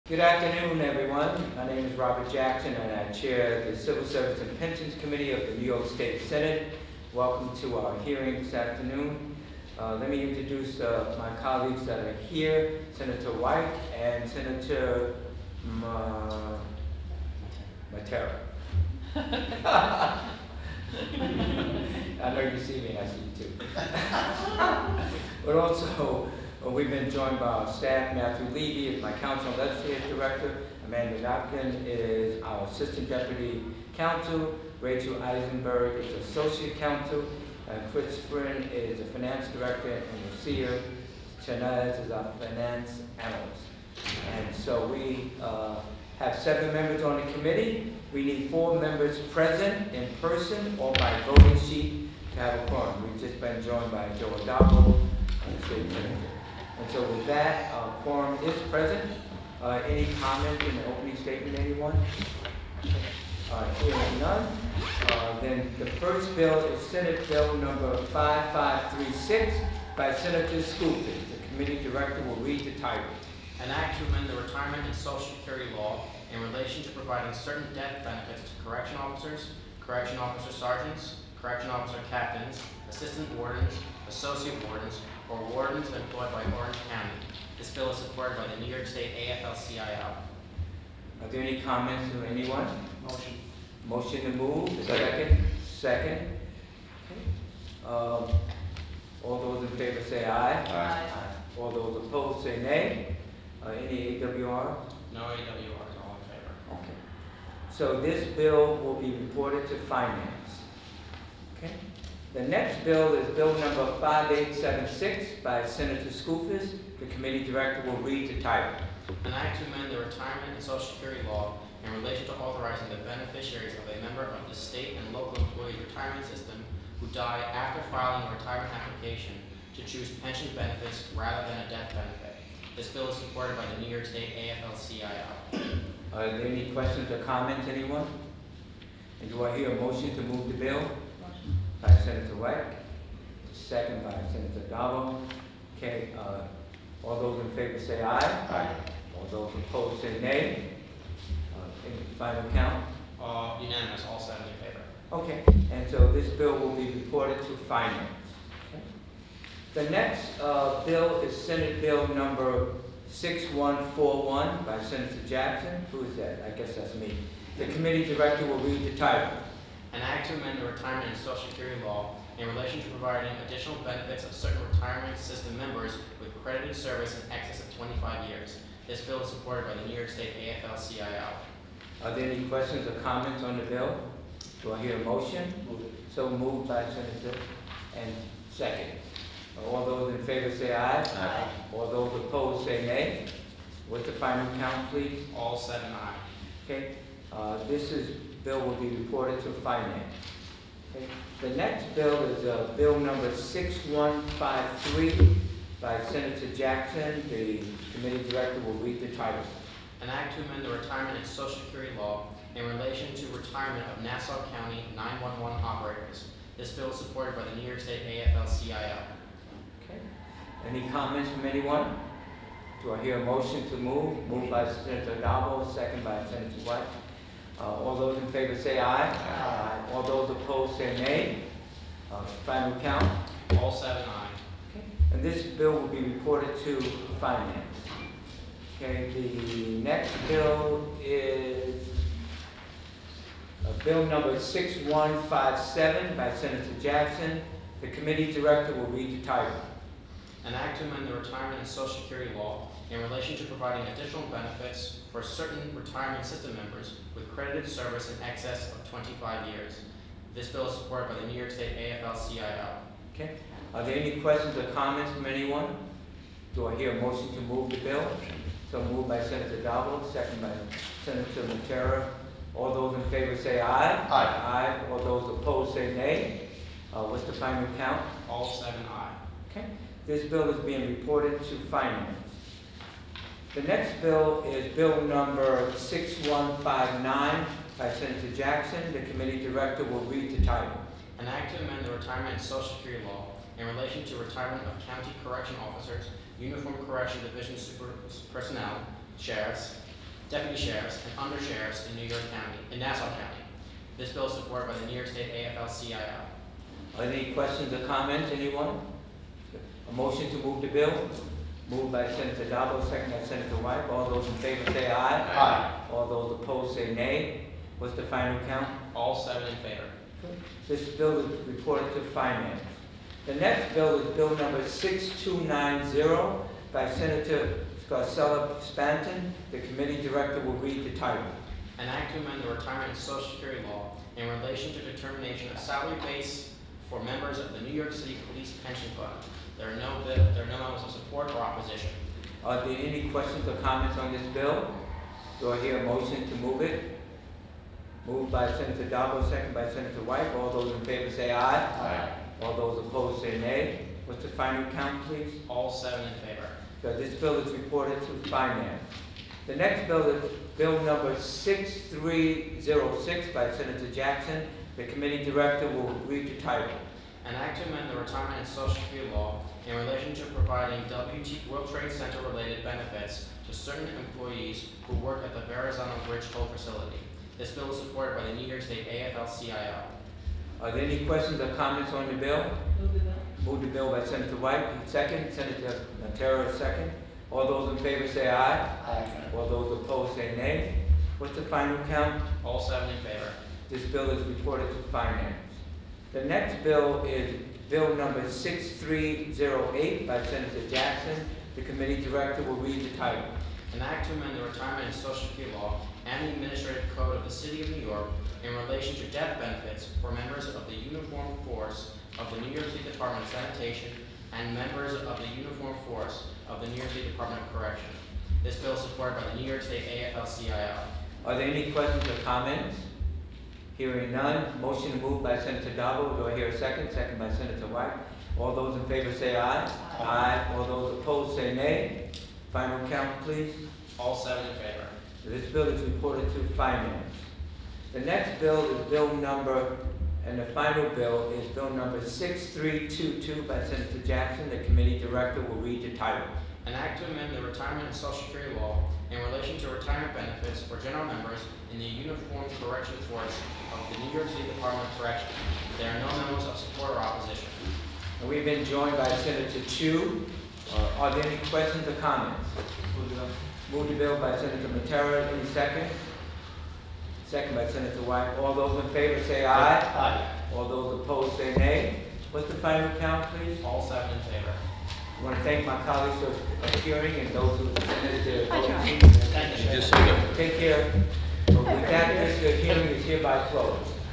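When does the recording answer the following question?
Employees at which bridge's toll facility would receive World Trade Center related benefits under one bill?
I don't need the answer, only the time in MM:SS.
06:15.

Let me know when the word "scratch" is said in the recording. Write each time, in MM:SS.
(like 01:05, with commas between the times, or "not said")
not said.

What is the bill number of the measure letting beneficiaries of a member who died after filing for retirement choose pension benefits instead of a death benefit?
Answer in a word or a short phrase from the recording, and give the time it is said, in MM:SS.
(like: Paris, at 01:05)
5876, at 01:54.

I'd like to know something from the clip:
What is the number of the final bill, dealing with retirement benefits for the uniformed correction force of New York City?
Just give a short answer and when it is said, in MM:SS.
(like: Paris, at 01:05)
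6322, at 07:22.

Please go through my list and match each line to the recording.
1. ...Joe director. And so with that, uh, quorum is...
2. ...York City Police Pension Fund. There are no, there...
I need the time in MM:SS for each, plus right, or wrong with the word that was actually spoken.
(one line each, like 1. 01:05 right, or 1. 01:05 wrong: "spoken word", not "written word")
1. 00:54 wrong: "senator", not "director"
2. 05:37 right.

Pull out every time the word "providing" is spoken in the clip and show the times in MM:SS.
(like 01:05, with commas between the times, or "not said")
01:16, 02:52, 04:13, 06:10.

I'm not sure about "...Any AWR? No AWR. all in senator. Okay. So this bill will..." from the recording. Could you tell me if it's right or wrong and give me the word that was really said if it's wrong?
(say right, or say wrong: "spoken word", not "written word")
wrong: "favor", not "senator".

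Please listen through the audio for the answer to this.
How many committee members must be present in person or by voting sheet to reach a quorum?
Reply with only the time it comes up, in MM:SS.
00:48.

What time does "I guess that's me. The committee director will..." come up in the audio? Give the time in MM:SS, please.
02:46.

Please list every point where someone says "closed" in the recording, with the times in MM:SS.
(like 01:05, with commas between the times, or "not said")
08:03.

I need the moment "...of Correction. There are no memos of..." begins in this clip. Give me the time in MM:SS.
07:34.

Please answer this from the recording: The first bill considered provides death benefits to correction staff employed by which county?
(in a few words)
Orange County.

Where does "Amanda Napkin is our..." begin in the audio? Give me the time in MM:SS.
00:30.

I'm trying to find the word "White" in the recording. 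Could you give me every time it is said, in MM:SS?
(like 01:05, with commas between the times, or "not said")
00:13, 02:22, 03:46, 05:13, 05:50, 06:24, 07:07, 07:48.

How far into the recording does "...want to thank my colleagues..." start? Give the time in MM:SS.
07:55.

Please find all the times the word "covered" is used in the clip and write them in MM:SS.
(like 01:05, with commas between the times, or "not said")
not said.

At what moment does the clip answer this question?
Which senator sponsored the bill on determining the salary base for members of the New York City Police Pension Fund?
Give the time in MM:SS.
05:27.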